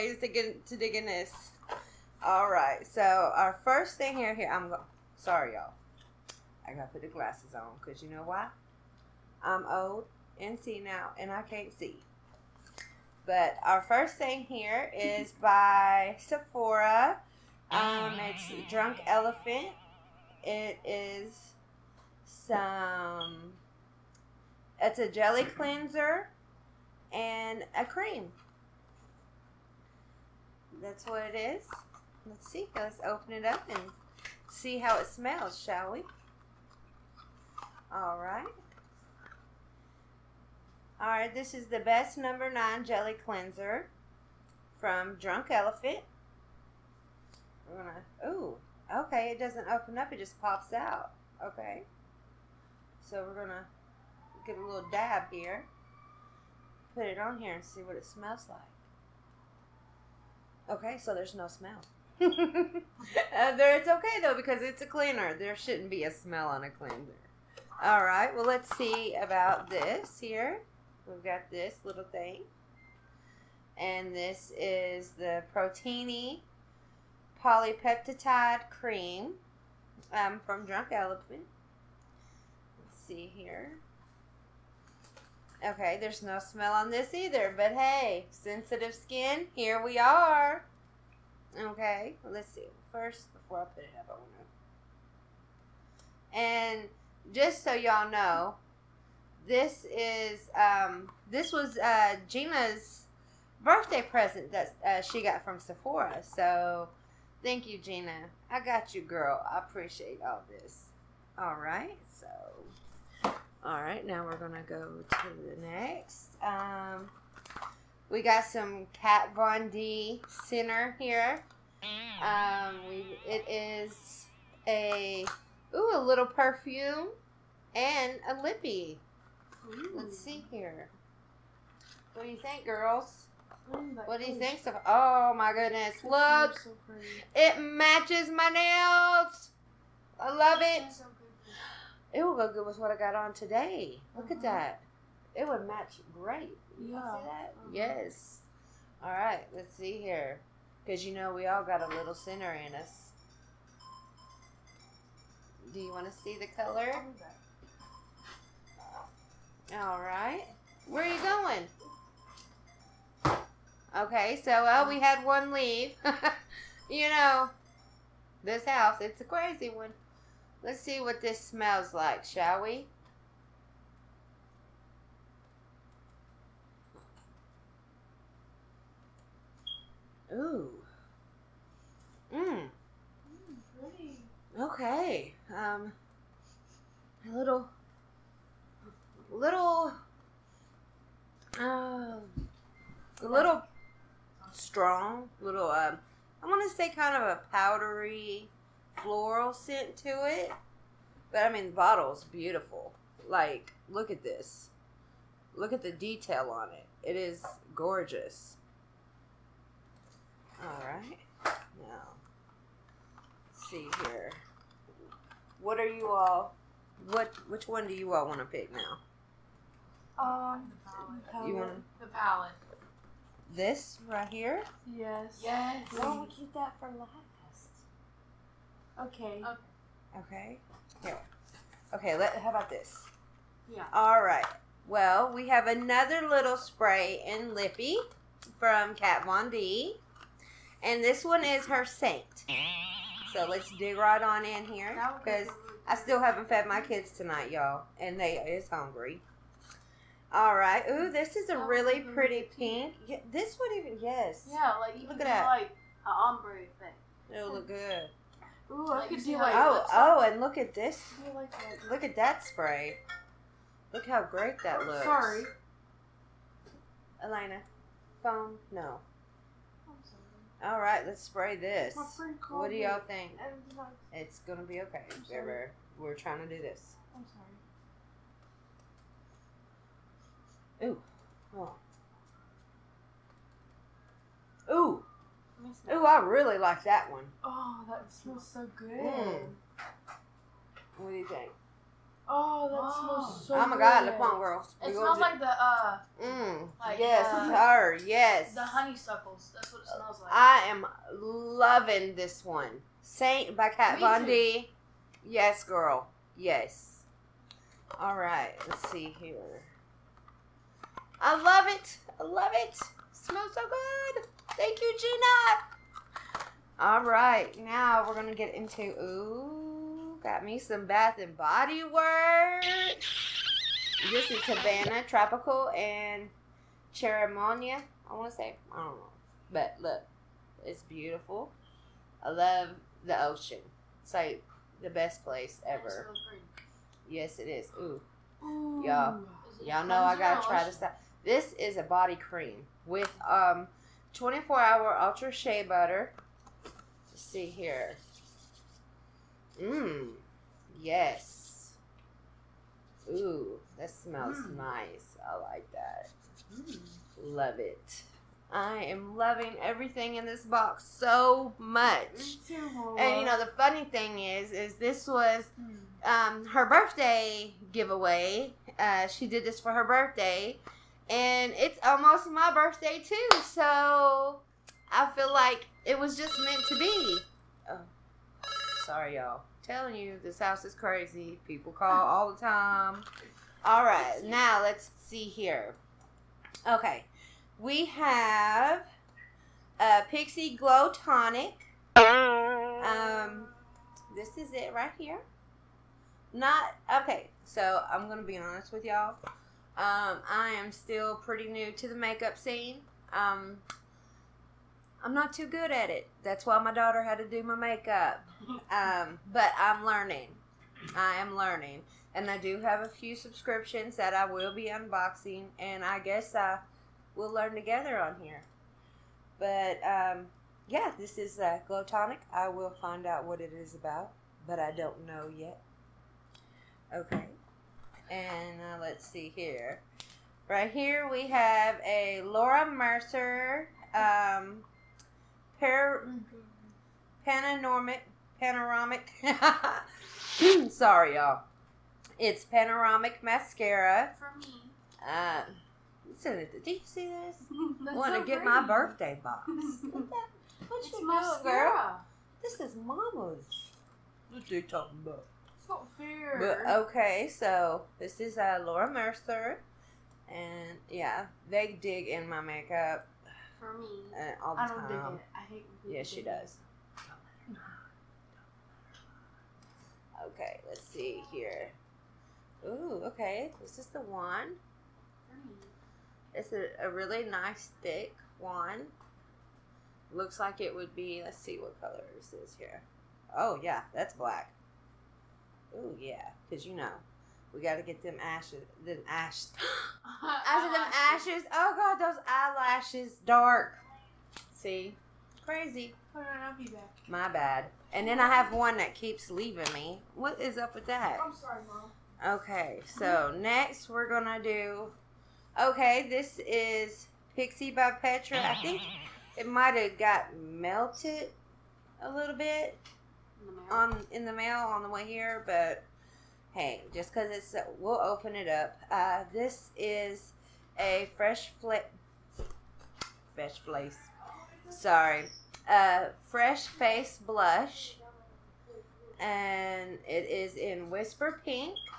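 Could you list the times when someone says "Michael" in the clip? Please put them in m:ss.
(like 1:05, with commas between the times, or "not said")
not said.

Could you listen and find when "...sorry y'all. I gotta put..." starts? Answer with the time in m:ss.
0:05.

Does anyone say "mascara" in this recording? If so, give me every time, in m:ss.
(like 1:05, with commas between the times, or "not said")
7:23, 7:31.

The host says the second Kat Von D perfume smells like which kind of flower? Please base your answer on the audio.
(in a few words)
Honeysuckles.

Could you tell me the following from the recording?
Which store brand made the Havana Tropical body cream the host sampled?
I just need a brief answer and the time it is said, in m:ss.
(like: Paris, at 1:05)
Bath and Body Works, at 5:20.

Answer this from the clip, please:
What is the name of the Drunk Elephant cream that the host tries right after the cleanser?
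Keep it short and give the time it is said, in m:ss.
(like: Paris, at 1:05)
Protini Polypeptide Cream, at 1:15.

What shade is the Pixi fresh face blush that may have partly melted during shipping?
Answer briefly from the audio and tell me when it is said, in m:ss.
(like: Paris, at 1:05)
Whisper pink, at 8:50.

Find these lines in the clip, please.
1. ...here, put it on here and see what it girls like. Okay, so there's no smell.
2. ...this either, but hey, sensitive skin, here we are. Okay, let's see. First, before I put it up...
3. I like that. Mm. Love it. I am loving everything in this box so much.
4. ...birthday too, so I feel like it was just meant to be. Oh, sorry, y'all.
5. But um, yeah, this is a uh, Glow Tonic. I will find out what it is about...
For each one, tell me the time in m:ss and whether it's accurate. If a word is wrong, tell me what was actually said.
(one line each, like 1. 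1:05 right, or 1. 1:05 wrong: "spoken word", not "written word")
1. 0:55 wrong: "smells", not "girls"
2. 1:26 right
3. 5:55 right
4. 6:12 right
5. 6:59 right.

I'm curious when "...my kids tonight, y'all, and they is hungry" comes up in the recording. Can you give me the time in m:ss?
4:06.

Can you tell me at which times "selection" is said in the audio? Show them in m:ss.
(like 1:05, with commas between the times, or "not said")
not said.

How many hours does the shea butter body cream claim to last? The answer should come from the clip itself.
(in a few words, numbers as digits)
24.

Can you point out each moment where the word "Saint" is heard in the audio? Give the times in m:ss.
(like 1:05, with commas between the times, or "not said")
4:01, 5:03.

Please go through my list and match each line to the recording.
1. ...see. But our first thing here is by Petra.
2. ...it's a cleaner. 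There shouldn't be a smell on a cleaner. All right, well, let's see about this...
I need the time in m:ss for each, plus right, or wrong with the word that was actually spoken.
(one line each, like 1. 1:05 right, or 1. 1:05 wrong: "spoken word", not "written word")
1. 0:11 wrong: "Sephora", not "Petra"
2. 1:04 right.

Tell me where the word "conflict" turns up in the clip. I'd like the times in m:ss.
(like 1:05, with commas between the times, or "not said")
not said.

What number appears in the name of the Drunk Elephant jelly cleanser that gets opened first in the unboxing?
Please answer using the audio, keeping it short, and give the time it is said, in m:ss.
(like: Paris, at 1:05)
9, at 0:42.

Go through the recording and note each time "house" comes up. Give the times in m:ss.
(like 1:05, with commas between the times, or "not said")
2:48, 6:20.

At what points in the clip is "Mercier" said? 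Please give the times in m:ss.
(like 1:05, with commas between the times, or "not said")
7:12, 7:38.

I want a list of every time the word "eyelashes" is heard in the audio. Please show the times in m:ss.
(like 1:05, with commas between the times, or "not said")
8:12.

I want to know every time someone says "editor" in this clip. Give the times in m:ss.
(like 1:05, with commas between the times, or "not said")
not said.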